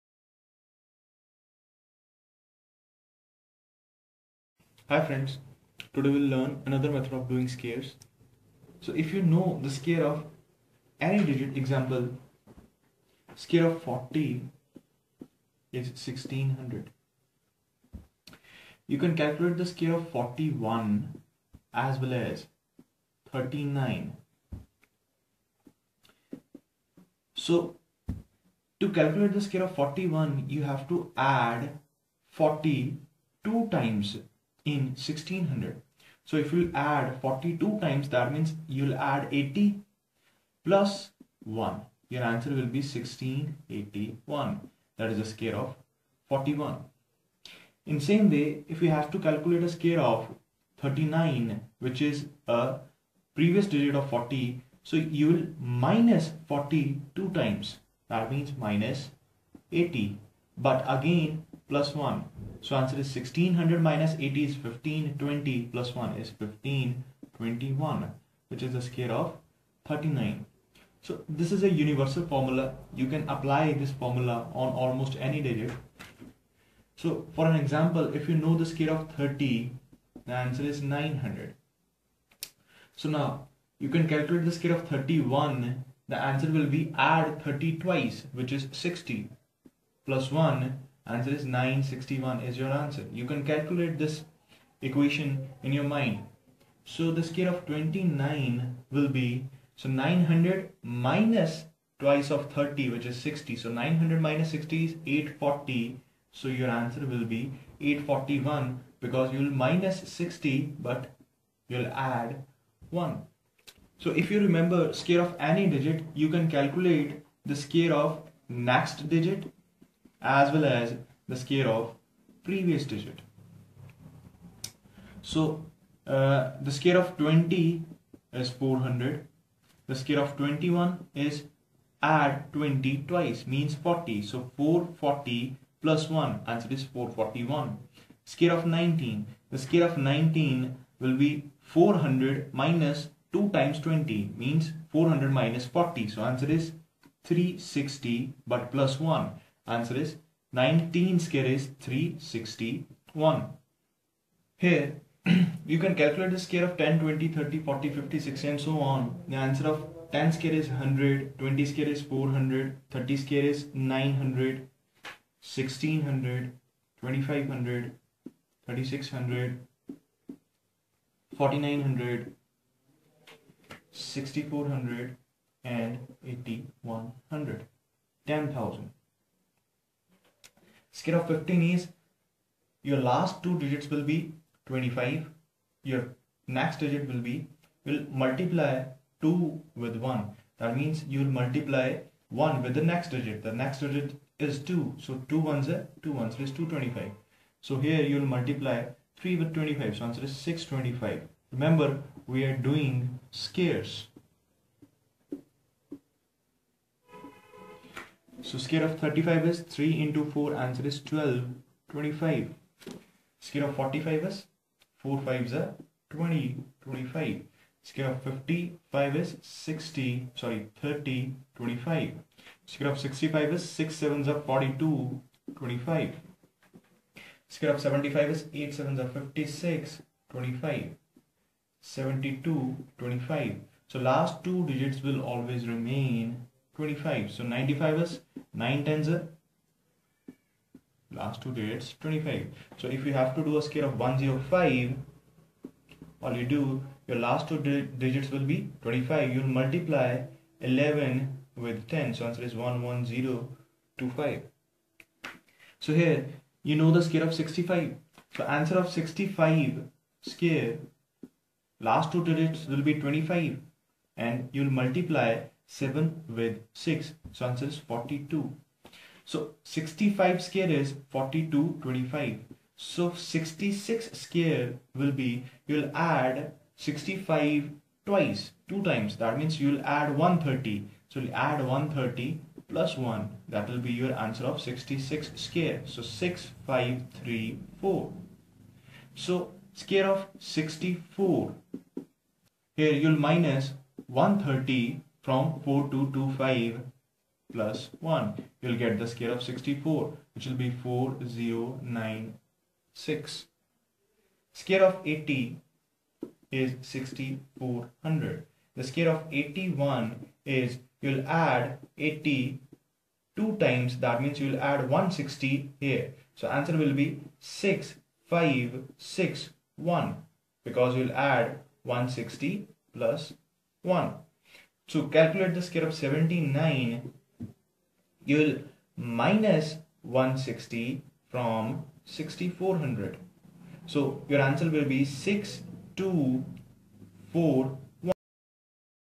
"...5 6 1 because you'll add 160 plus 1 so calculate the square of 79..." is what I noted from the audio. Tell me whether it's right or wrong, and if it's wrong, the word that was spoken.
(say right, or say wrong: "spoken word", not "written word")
right.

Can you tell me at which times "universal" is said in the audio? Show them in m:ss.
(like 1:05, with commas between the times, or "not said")
1:11.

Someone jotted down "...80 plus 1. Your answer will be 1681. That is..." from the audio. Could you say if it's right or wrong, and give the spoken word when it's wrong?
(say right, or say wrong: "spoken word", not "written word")
right.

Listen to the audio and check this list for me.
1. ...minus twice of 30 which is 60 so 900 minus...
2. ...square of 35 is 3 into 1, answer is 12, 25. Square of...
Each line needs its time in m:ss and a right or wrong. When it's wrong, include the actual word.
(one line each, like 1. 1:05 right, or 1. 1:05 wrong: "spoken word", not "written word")
1. 1:40 right
2. 3:28 wrong: "4", not "1".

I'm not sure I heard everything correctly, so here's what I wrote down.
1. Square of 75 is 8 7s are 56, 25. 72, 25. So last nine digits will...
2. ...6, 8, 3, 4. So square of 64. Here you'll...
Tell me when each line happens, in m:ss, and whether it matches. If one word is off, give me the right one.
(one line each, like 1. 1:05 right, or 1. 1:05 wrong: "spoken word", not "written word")
1. 3:47 wrong: "two", not "nine"
2. 4:46 wrong: "5", not "8".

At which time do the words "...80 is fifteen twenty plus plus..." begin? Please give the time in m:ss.
1:04.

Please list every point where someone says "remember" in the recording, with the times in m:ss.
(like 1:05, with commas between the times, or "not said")
1:54, 3:21.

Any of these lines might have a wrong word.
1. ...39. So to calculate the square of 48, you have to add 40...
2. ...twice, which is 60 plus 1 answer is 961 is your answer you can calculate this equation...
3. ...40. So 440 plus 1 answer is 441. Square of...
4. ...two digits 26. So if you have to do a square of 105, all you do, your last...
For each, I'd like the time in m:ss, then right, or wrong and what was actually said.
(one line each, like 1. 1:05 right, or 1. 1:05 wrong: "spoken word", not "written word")
1. 0:23 wrong: "41", not "48"
2. 1:27 right
3. 2:13 right
4. 4:01 wrong: "25", not "26".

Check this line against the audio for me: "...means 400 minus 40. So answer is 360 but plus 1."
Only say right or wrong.
right.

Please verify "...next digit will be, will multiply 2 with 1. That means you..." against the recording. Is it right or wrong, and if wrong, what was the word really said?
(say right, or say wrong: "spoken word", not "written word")
right.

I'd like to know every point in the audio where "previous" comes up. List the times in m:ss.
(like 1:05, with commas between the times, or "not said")
0:53, 2:02.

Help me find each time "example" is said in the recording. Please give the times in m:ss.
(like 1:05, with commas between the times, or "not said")
0:11, 1:17.